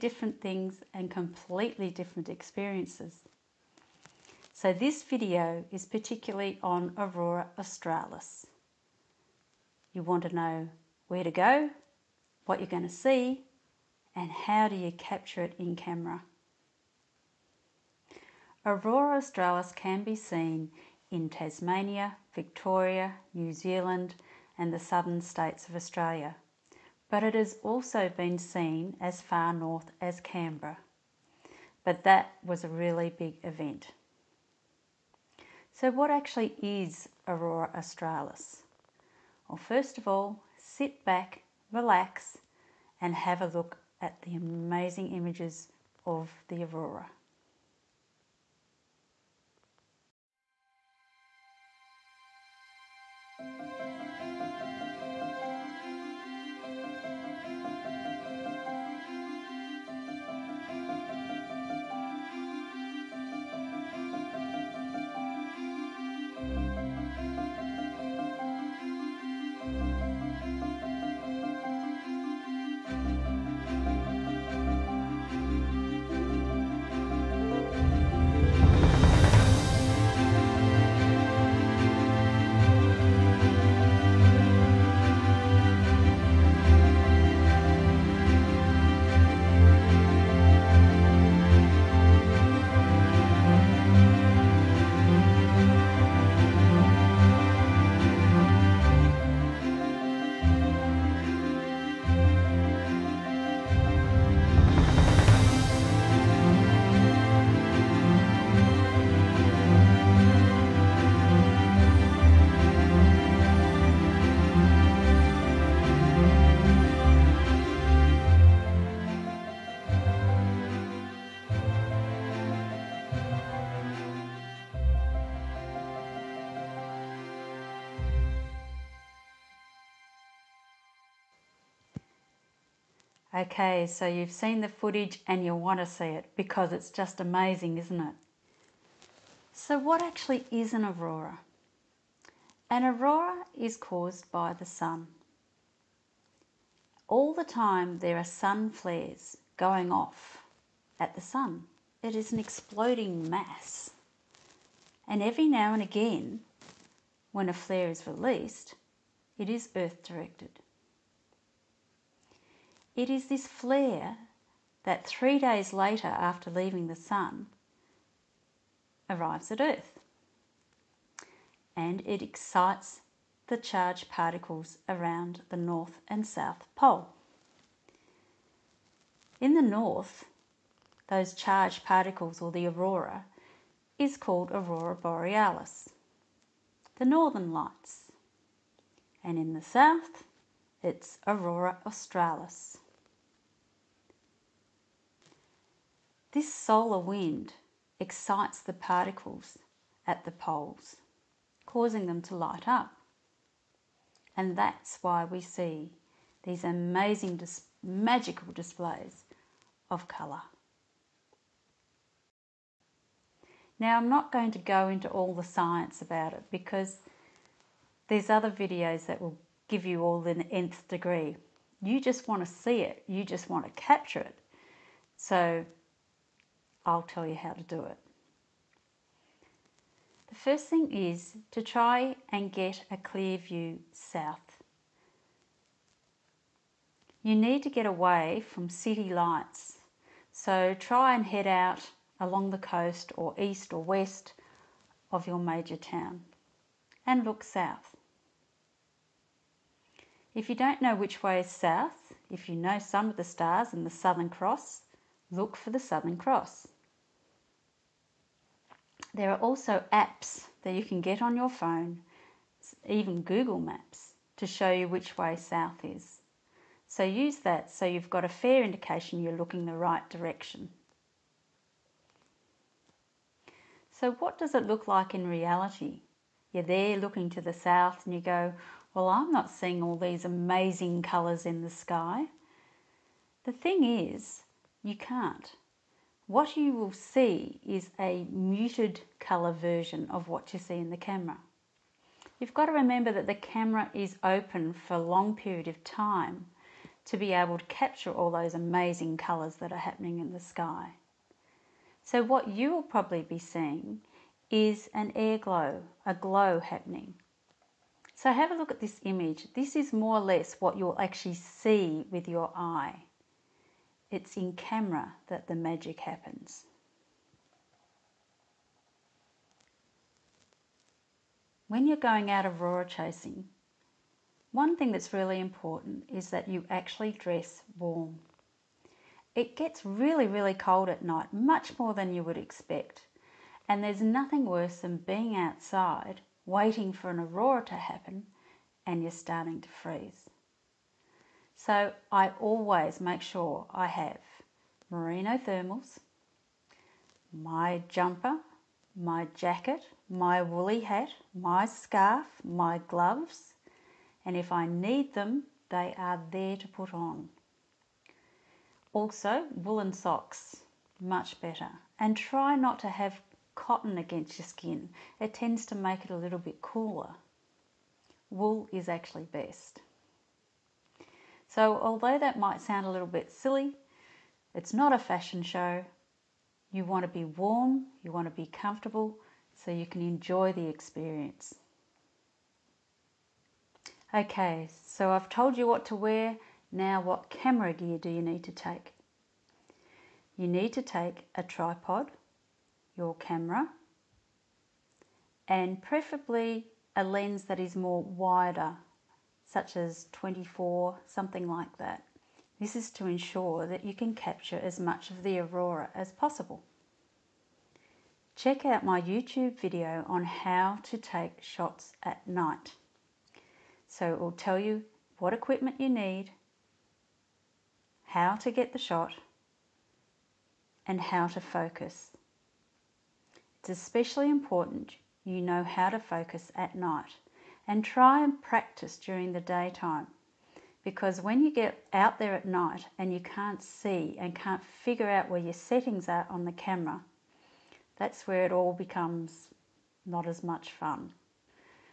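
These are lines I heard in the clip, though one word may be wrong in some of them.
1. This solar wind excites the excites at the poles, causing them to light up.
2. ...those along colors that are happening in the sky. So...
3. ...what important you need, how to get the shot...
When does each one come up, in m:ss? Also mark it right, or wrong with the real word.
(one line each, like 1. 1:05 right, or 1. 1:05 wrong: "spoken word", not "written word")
1. 3:16 wrong: "particles", not "excites"
2. 4:58 wrong: "amazing", not "along"
3. 6:55 wrong: "equipment", not "important".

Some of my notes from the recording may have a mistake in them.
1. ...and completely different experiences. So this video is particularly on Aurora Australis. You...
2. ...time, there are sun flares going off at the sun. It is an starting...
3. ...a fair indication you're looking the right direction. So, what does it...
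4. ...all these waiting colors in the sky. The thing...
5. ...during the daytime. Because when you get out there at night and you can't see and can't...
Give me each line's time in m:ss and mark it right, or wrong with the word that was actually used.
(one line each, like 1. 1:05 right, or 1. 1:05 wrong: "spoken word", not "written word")
1. 0:00 right
2. 2:27 wrong: "exploding", not "starting"
3. 4:28 right
4. 4:39 wrong: "amazing", not "waiting"
5. 7:08 right.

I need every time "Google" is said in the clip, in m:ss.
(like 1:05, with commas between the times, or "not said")
4:23.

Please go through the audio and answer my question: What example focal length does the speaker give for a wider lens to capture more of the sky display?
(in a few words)
24.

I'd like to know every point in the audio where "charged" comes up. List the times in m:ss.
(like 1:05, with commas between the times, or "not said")
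2:53, 3:01.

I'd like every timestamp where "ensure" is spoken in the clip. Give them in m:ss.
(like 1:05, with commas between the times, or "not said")
6:43.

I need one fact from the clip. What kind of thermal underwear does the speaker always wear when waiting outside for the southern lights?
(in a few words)
merino thermals.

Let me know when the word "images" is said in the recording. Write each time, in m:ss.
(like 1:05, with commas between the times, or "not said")
0:45, 5:09.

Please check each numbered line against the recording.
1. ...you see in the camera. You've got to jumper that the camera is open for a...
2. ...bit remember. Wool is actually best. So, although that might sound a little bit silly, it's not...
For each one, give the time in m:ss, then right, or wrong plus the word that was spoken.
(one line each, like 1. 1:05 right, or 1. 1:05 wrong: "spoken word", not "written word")
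1. 4:50 wrong: "remember", not "jumper"
2. 6:06 wrong: "cooler", not "remember".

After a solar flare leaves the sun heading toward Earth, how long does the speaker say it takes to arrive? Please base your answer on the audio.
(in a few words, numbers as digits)
3 days.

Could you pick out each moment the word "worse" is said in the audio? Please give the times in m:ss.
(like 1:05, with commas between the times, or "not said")
5:34.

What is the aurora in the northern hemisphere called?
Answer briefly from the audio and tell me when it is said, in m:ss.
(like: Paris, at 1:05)
northern lights, at 3:06.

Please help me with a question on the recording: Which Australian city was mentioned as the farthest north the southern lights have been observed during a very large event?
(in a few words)
Canberra.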